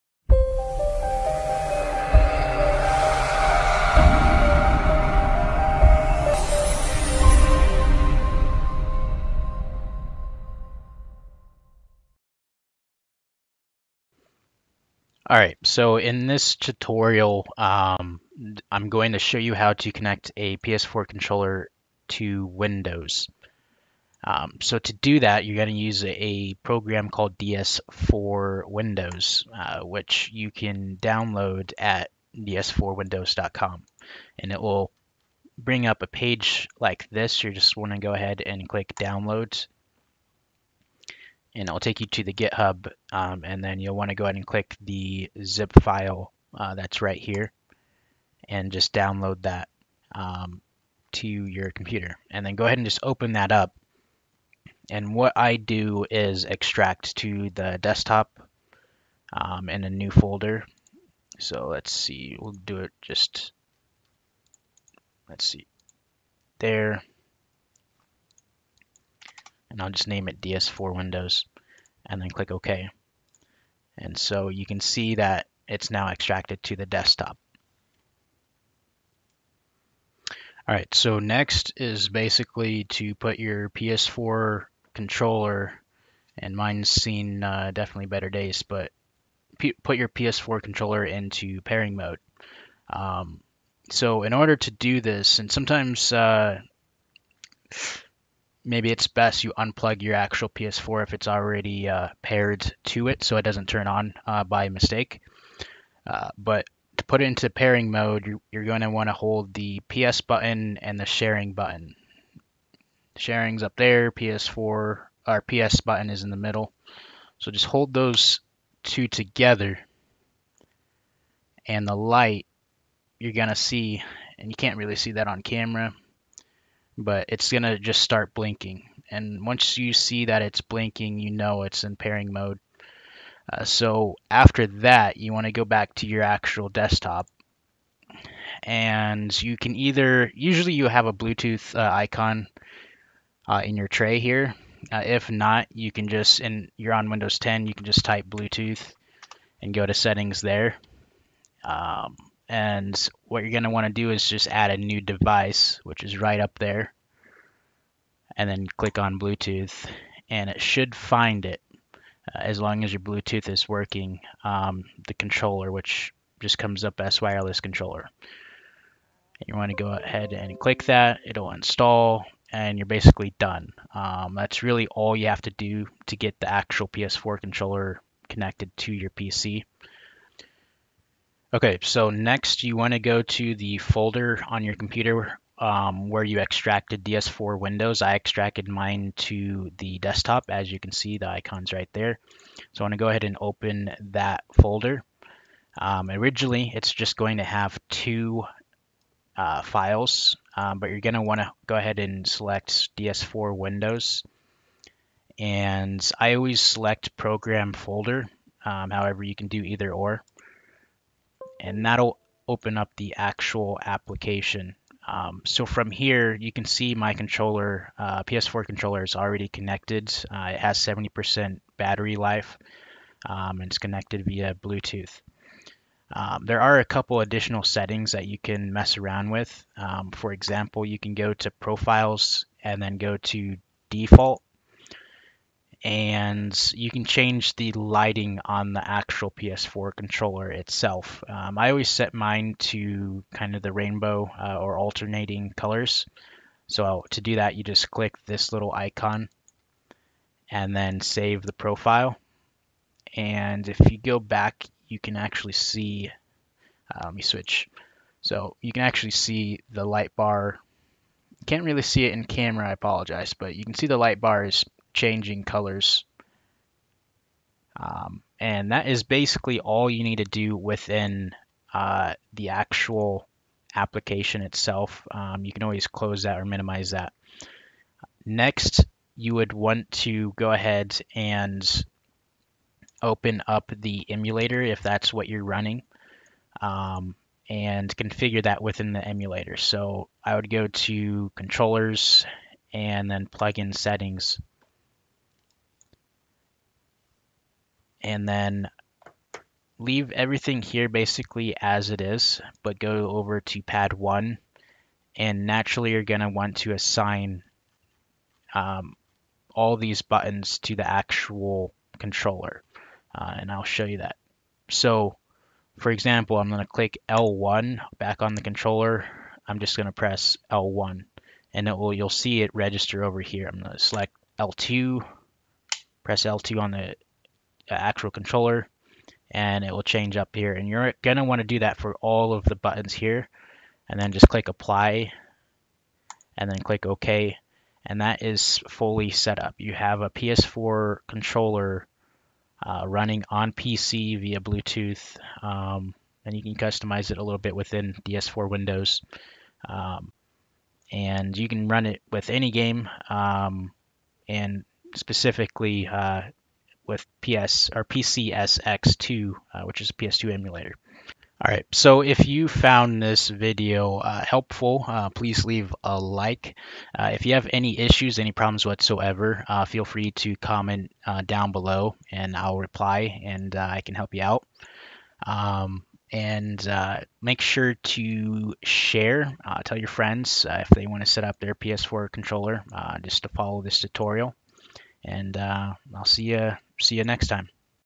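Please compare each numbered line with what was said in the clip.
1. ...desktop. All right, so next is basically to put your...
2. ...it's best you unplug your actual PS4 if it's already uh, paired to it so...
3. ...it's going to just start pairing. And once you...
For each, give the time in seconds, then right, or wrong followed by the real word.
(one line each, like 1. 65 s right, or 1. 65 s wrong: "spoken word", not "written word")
1. 76 s right
2. 98 s right
3. 127 s wrong: "blinking", not "pairing".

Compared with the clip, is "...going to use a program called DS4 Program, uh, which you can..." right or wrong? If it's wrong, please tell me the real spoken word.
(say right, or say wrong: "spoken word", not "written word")
wrong: "Windows", not "Program".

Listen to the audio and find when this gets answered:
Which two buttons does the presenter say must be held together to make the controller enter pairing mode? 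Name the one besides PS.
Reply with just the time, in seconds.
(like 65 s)
109 s.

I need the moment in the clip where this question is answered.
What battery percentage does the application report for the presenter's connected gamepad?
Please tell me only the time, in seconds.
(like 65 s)
220 s.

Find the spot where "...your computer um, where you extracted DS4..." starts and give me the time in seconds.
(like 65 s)
184 s.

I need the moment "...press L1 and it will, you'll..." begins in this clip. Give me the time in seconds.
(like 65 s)
319 s.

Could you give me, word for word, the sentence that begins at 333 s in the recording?
And then just click apply and then click OK.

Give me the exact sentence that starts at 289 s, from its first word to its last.
So I would go to controllers and then plug in settings.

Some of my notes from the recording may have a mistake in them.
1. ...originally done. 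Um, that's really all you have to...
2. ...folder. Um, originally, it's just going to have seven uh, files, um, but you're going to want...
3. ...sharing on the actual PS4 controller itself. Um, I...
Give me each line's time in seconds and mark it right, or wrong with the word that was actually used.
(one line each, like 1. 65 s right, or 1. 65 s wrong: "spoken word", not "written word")
1. 172 s wrong: "basically", not "originally"
2. 194 s wrong: "two", not "seven"
3. 237 s wrong: "lighting", not "sharing".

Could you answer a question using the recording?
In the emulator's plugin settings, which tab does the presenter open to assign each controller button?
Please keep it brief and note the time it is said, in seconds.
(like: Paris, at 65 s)
Pad one, at 302 s.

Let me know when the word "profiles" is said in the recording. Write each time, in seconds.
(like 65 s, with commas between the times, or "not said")
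231 s, 251 s.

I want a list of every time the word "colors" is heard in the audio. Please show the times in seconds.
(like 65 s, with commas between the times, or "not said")
245 s, 265 s.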